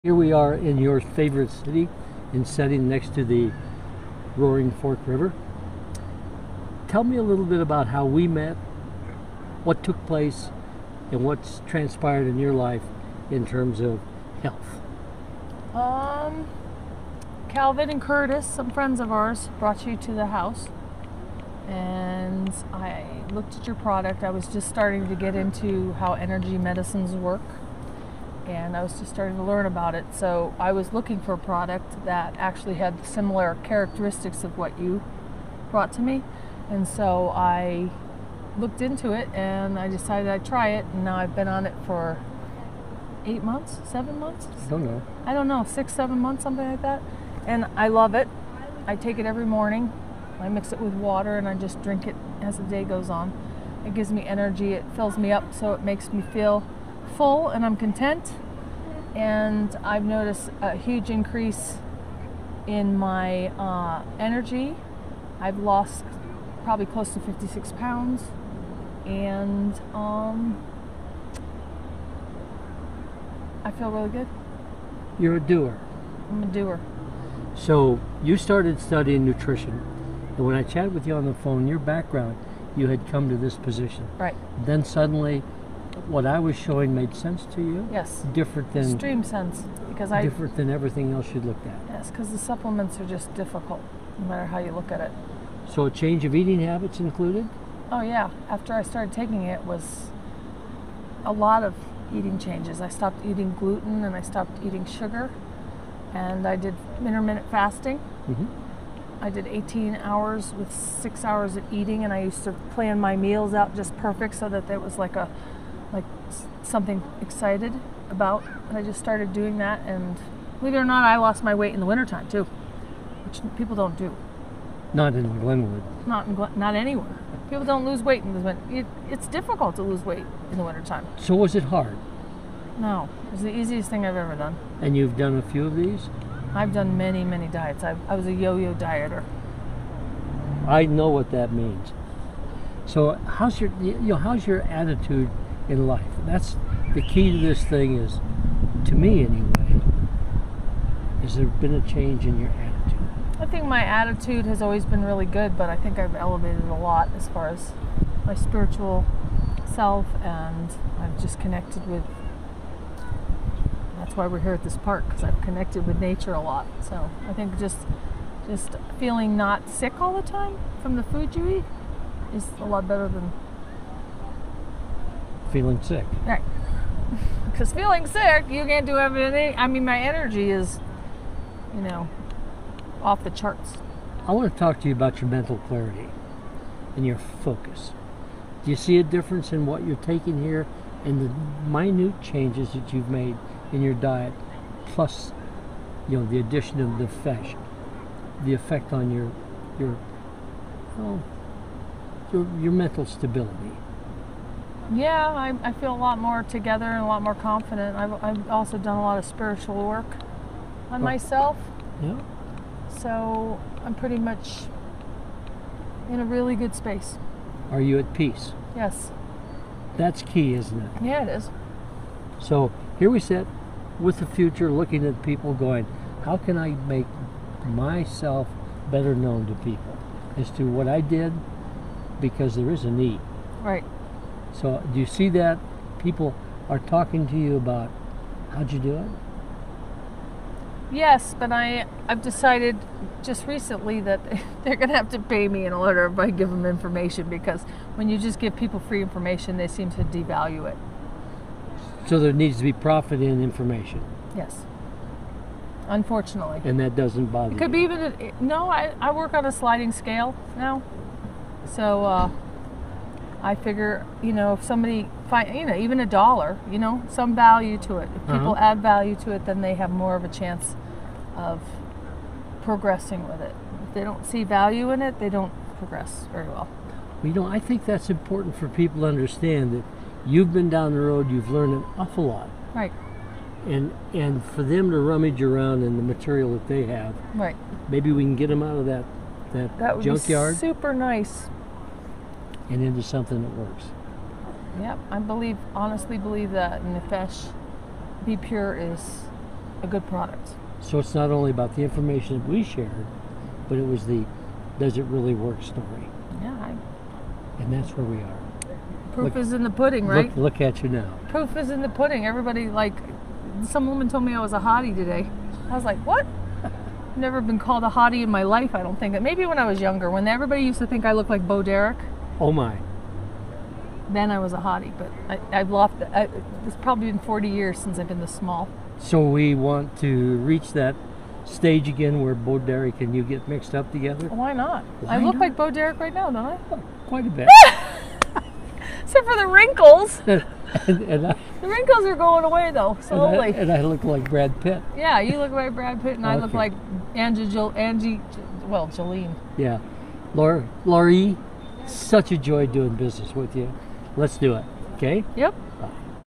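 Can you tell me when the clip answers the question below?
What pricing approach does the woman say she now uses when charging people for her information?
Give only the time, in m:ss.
4:19.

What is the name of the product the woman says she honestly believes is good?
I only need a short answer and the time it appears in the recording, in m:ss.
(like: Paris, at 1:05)
Nefesh Be Pure, at 4:56.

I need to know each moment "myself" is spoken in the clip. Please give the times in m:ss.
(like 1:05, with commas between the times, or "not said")
3:31, 3:47.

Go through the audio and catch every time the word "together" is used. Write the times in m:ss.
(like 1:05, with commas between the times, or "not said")
3:26, 5:33.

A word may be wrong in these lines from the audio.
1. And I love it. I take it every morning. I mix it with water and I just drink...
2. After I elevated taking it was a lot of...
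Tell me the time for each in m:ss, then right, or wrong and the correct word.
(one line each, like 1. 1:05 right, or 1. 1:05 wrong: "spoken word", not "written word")
1. 0:47 right
2. 1:38 wrong: "started", not "elevated".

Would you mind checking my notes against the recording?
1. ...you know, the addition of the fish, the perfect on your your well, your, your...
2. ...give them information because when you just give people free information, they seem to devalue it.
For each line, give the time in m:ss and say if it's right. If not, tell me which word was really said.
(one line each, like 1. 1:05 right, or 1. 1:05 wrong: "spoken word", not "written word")
1. 3:16 wrong: "effect", not "perfect"
2. 4:06 right.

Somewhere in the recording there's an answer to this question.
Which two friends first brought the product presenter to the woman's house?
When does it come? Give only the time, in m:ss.
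0:17.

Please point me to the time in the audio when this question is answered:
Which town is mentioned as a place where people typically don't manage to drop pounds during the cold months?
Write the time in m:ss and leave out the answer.
2:05.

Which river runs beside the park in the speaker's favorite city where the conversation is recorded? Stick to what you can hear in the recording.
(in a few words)
Roaring Fork River.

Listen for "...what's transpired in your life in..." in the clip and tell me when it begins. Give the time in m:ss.
0:11.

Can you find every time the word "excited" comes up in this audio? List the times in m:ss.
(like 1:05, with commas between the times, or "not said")
1:57.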